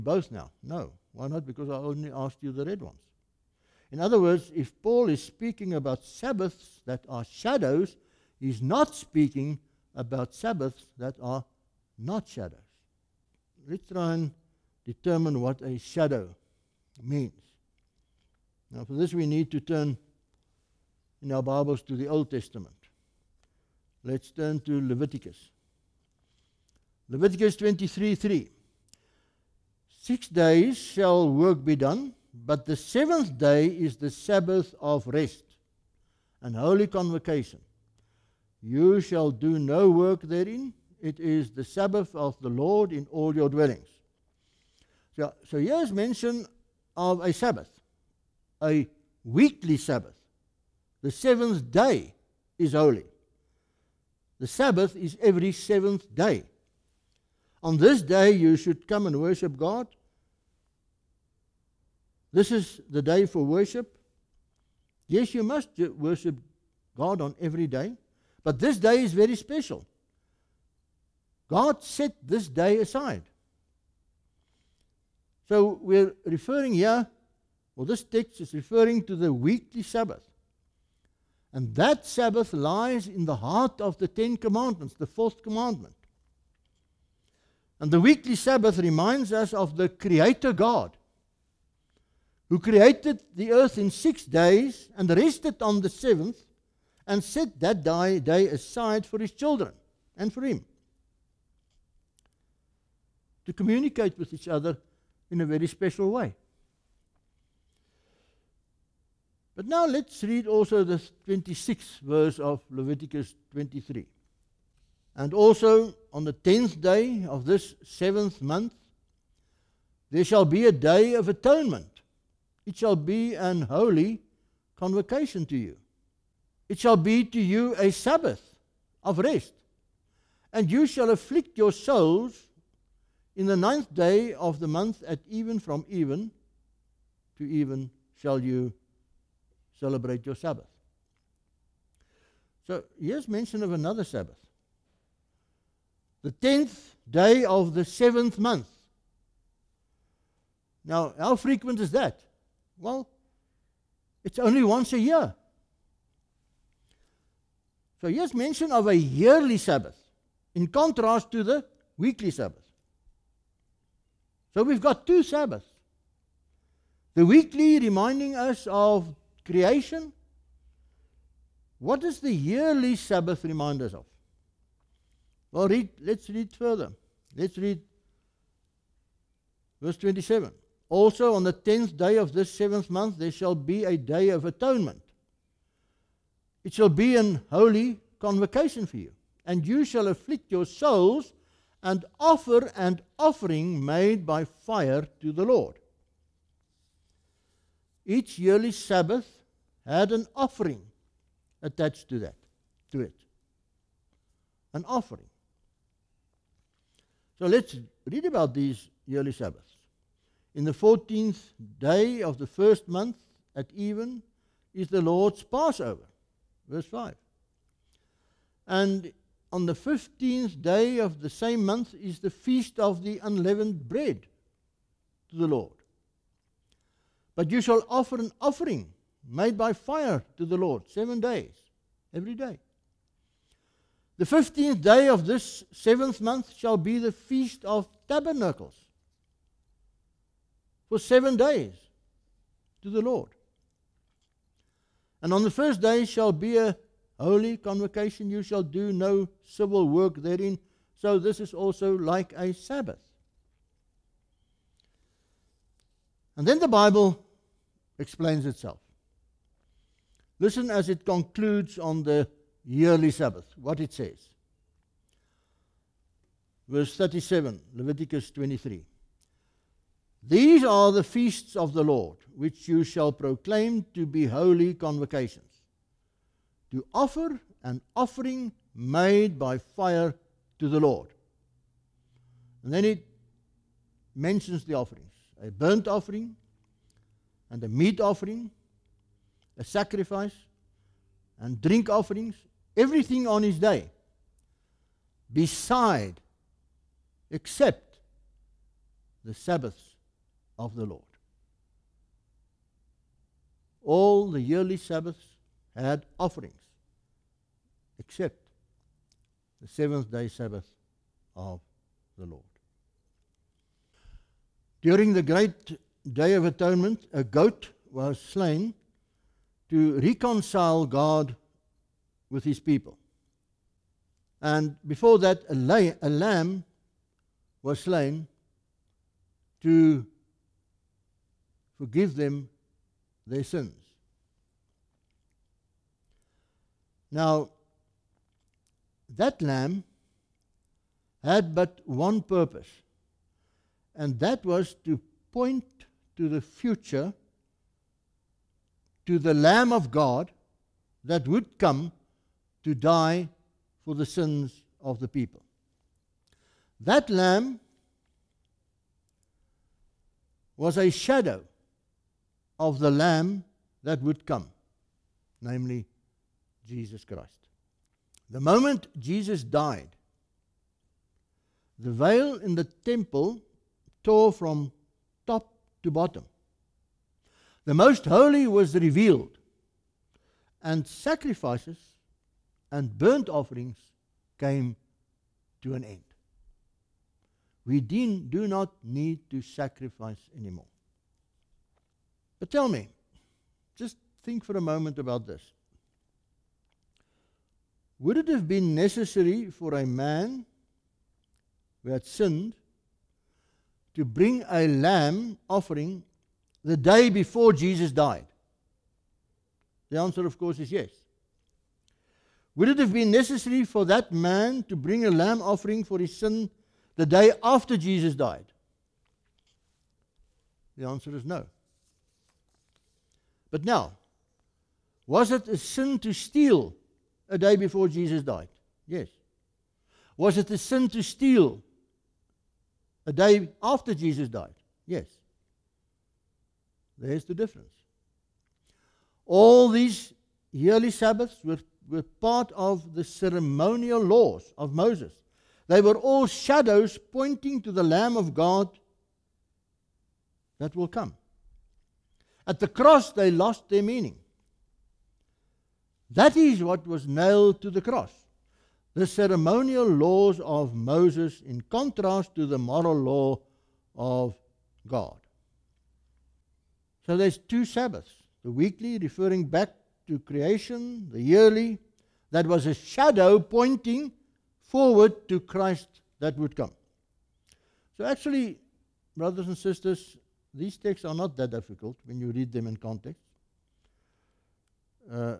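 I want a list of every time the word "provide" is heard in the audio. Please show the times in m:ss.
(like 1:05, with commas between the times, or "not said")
not said.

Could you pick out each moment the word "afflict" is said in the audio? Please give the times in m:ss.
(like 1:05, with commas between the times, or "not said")
2:11, 3:10.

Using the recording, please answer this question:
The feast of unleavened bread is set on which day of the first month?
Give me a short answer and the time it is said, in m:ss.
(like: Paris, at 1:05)
15th day, at 3:39.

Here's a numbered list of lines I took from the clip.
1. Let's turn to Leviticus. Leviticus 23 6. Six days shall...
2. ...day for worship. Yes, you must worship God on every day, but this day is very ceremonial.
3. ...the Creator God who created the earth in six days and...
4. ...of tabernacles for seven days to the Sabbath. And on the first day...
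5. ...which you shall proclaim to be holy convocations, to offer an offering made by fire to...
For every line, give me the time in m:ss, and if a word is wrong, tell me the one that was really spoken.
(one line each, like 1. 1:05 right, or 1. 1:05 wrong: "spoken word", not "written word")
1. 0:24 wrong: "3", not "6"
2. 1:03 wrong: "special", not "ceremonial"
3. 1:29 right
4. 3:57 wrong: "Lord", not "Sabbath"
5. 4:32 right.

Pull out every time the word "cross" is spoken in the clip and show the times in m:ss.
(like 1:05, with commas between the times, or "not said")
7:32, 7:37.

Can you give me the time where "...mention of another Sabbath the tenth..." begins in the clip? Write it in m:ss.
2:23.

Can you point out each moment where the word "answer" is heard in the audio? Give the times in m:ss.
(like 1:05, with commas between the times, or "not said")
6:49, 7:00.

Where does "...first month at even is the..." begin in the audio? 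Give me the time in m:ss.
3:32.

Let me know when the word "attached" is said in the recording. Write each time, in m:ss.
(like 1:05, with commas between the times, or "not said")
3:21.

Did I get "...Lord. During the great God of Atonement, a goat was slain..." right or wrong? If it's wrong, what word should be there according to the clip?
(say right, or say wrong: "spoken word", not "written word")
wrong: "Day", not "God".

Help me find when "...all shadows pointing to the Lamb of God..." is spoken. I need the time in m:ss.
7:25.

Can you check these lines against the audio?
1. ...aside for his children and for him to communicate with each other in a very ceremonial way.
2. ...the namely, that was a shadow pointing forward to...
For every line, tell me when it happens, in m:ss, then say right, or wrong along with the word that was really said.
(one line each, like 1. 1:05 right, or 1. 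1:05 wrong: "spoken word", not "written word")
1. 1:38 wrong: "special", not "ceremonial"
2. 7:51 wrong: "yearly", not "namely".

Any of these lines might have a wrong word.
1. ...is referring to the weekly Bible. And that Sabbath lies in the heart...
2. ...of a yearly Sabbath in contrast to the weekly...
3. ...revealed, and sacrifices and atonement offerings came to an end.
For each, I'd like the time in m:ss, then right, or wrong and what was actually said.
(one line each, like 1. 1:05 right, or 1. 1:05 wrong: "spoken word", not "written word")
1. 1:18 wrong: "Sabbath", not "Bible"
2. 2:38 right
3. 6:18 wrong: "burnt", not "atonement".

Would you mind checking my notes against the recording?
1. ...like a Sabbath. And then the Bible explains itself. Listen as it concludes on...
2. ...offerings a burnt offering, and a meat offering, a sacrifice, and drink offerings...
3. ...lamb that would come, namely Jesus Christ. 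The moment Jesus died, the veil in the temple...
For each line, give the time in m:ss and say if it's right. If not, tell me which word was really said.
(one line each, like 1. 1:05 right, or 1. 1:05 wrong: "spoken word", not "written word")
1. 4:11 right
2. 4:44 right
3. 6:02 right.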